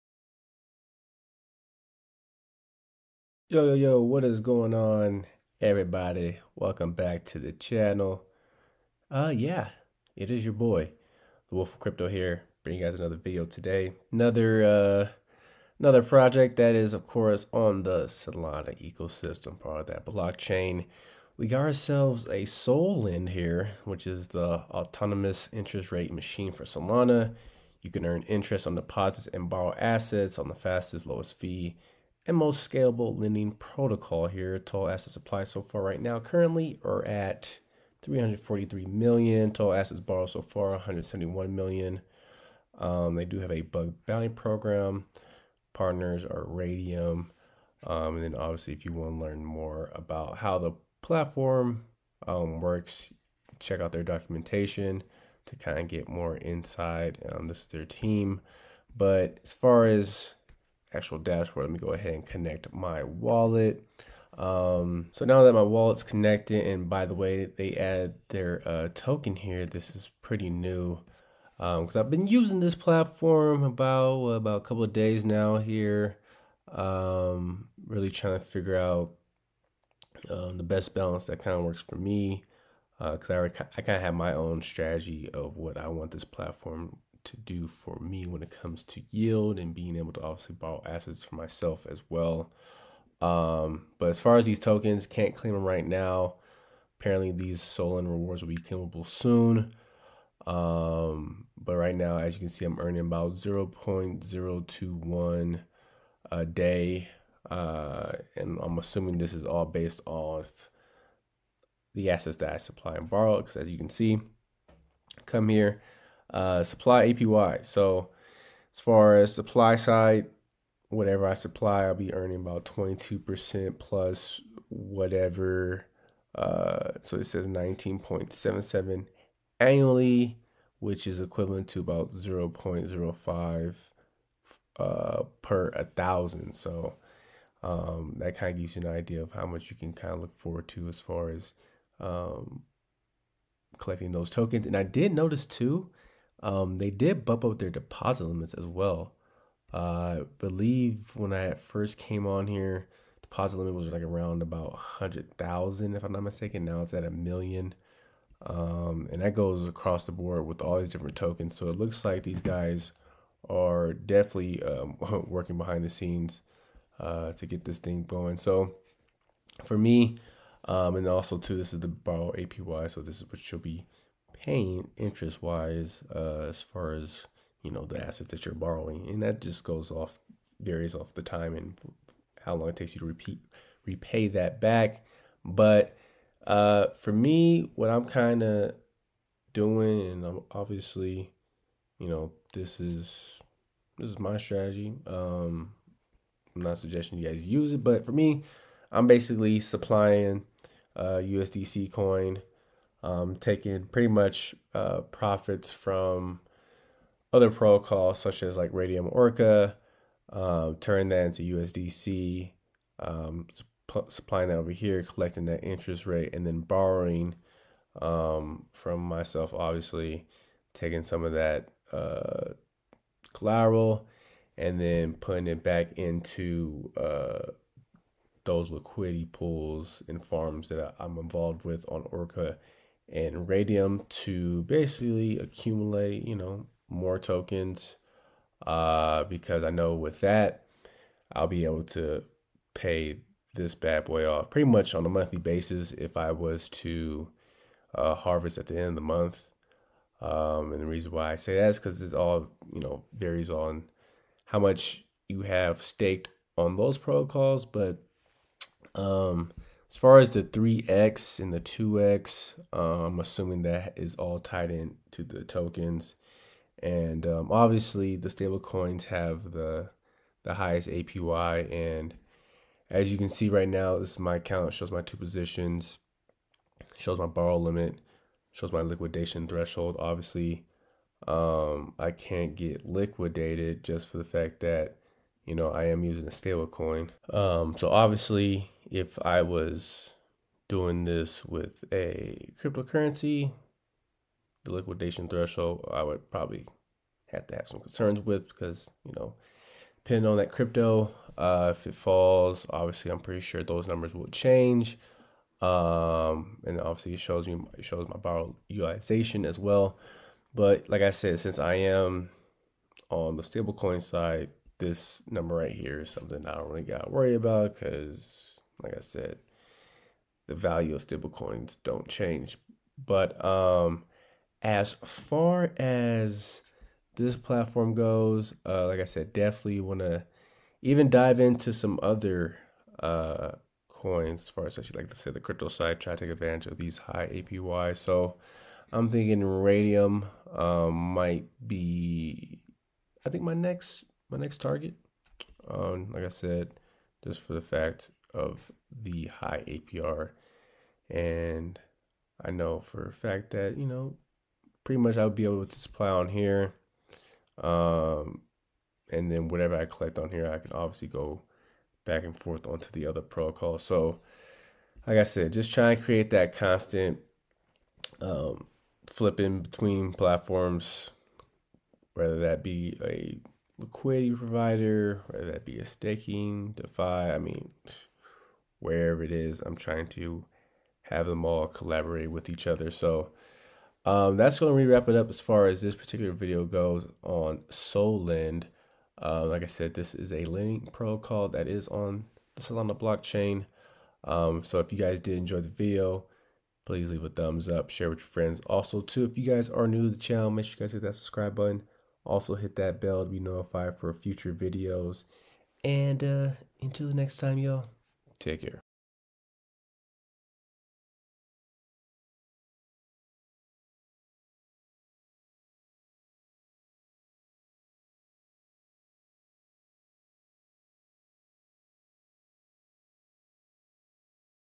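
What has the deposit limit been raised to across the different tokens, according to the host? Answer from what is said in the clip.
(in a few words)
a million.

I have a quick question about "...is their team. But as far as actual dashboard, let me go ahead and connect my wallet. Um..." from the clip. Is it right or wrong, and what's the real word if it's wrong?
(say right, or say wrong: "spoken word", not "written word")
right.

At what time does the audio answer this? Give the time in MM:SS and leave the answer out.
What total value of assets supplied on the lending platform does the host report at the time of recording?
00:38.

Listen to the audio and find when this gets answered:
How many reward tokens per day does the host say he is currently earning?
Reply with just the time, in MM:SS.
01:43.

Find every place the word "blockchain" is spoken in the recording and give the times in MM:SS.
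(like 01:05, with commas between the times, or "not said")
00:20, 06:32.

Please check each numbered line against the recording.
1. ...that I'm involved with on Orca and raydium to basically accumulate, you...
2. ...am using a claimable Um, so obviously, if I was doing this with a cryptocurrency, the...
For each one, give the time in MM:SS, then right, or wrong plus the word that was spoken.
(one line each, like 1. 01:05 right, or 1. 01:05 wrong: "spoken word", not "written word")
1. 03:50 right
2. 04:45 wrong: "stable", not "claimable".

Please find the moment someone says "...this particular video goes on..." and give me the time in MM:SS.
06:25.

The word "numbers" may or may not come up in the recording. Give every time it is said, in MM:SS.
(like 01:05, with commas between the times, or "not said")
05:03, 05:15.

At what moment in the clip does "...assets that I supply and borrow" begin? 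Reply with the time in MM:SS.
01:52.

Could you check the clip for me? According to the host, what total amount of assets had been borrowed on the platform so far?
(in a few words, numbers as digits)
171 million.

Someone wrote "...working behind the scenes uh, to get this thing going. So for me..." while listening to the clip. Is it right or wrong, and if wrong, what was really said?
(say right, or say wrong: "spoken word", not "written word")
right.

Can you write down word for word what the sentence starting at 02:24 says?
And I did notice too um, they did bump up their deposit limits as well.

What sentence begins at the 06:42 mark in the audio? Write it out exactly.
Also hit that bell to be notified for future videos.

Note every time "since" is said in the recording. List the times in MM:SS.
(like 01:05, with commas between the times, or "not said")
05:11.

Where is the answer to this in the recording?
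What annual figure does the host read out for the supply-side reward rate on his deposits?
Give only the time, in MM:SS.
02:07.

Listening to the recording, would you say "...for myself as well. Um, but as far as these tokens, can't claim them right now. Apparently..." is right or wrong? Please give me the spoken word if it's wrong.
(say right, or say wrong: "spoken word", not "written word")
right.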